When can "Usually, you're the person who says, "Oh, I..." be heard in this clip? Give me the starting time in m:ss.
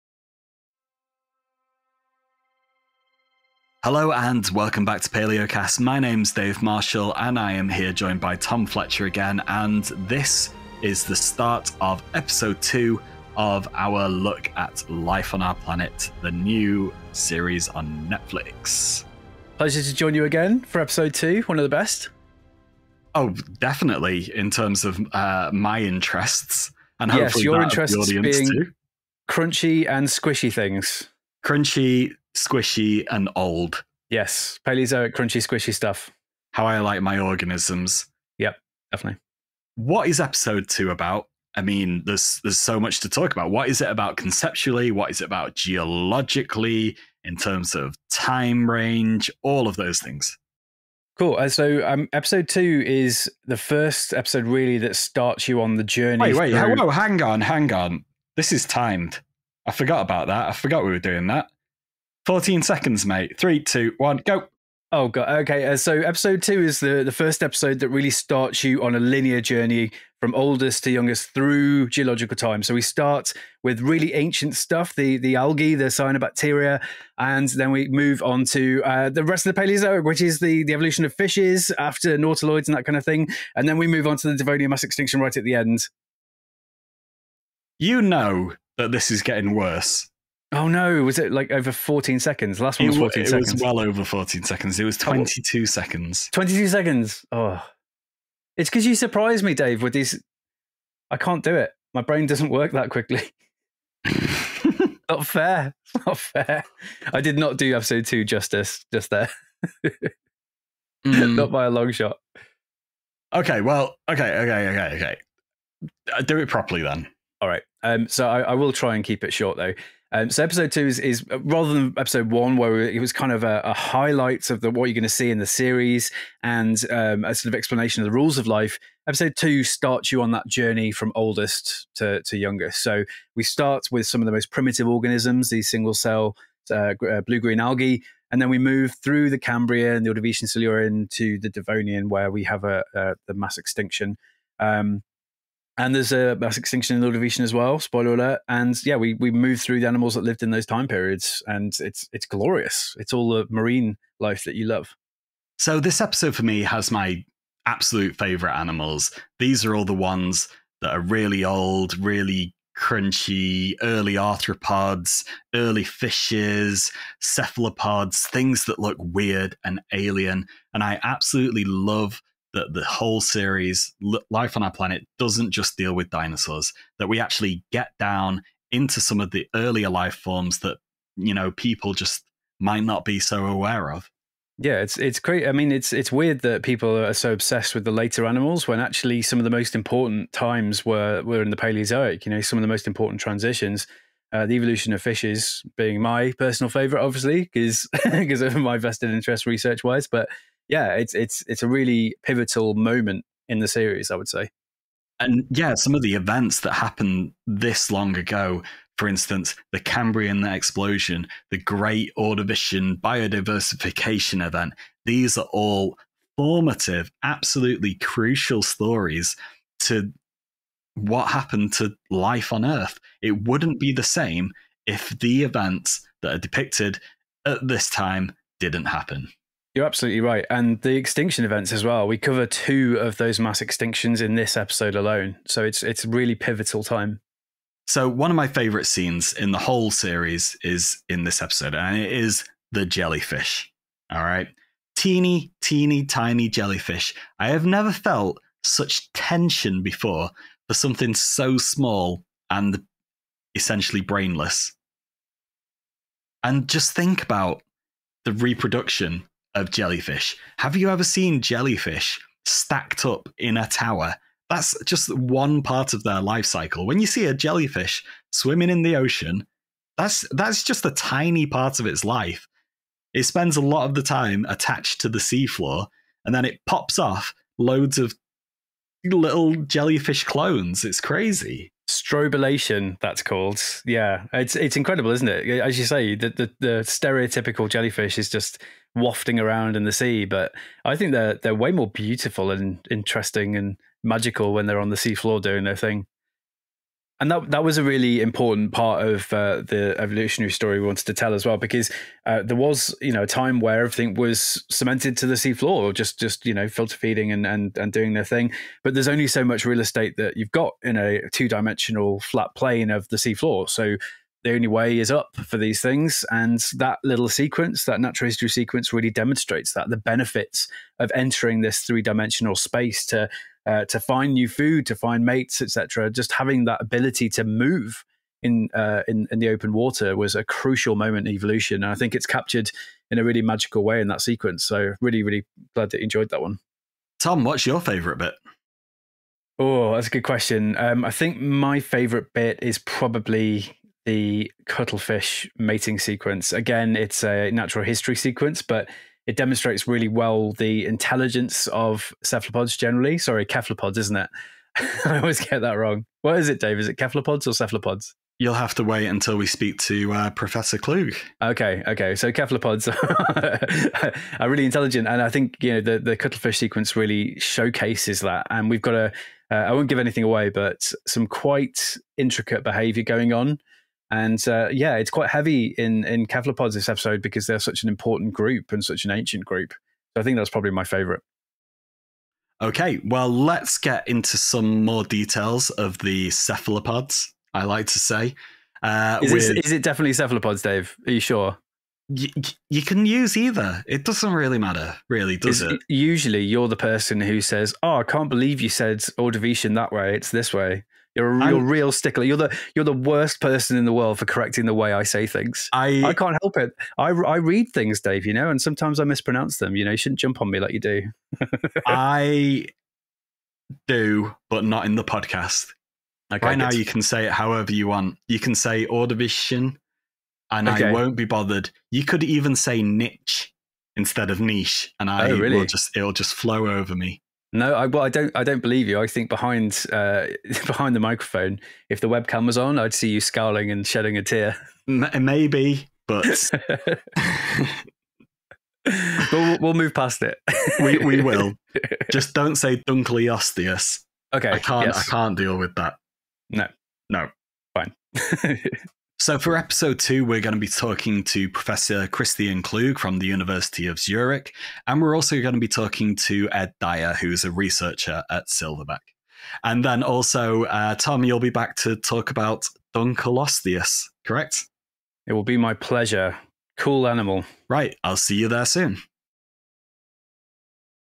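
6:35.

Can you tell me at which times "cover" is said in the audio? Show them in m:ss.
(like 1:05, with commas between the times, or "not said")
3:52.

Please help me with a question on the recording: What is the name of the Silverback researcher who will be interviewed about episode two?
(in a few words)
Ed Dyer.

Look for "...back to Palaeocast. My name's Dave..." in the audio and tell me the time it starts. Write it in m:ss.
0:04.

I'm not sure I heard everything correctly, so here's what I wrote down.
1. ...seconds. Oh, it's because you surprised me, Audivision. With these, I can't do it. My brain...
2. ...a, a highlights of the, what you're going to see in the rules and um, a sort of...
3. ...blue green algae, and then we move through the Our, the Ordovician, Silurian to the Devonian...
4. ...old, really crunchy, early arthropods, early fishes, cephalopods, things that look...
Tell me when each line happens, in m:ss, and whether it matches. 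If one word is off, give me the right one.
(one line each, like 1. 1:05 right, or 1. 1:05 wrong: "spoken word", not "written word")
1. 1:36 wrong: "Dave", not "Audivision"
2. 2:03 wrong: "series", not "rules"
3. 2:17 wrong: "Cambrian", not "Our"
4. 2:41 right.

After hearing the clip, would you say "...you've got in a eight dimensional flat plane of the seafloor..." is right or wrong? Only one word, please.
wrong.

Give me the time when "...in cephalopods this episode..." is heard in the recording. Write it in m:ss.
6:16.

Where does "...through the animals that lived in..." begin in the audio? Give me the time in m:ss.
2:29.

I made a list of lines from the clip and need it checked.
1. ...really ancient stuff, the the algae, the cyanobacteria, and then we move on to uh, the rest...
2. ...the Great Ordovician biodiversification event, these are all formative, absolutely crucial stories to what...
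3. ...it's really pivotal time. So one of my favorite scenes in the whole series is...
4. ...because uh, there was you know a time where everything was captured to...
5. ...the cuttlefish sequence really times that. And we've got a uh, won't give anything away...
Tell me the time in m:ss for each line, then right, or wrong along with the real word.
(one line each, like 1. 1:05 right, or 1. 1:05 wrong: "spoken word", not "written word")
1. 1:13 right
2. 3:31 right
3. 3:55 right
4. 5:01 wrong: "cemented", not "captured"
5. 6:05 wrong: "showcases", not "times".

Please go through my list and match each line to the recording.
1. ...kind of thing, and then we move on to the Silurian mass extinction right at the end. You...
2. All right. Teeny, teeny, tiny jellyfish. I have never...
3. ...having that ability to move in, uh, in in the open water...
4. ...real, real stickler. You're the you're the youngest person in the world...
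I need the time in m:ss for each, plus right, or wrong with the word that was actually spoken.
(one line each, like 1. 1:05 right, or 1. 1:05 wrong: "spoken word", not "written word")
1. 1:22 wrong: "Devonian", not "Silurian"
2. 4:04 right
3. 5:26 right
4. 6:41 wrong: "worst", not "youngest".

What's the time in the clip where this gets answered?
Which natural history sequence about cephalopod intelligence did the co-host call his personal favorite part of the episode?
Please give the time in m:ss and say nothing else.
5:44.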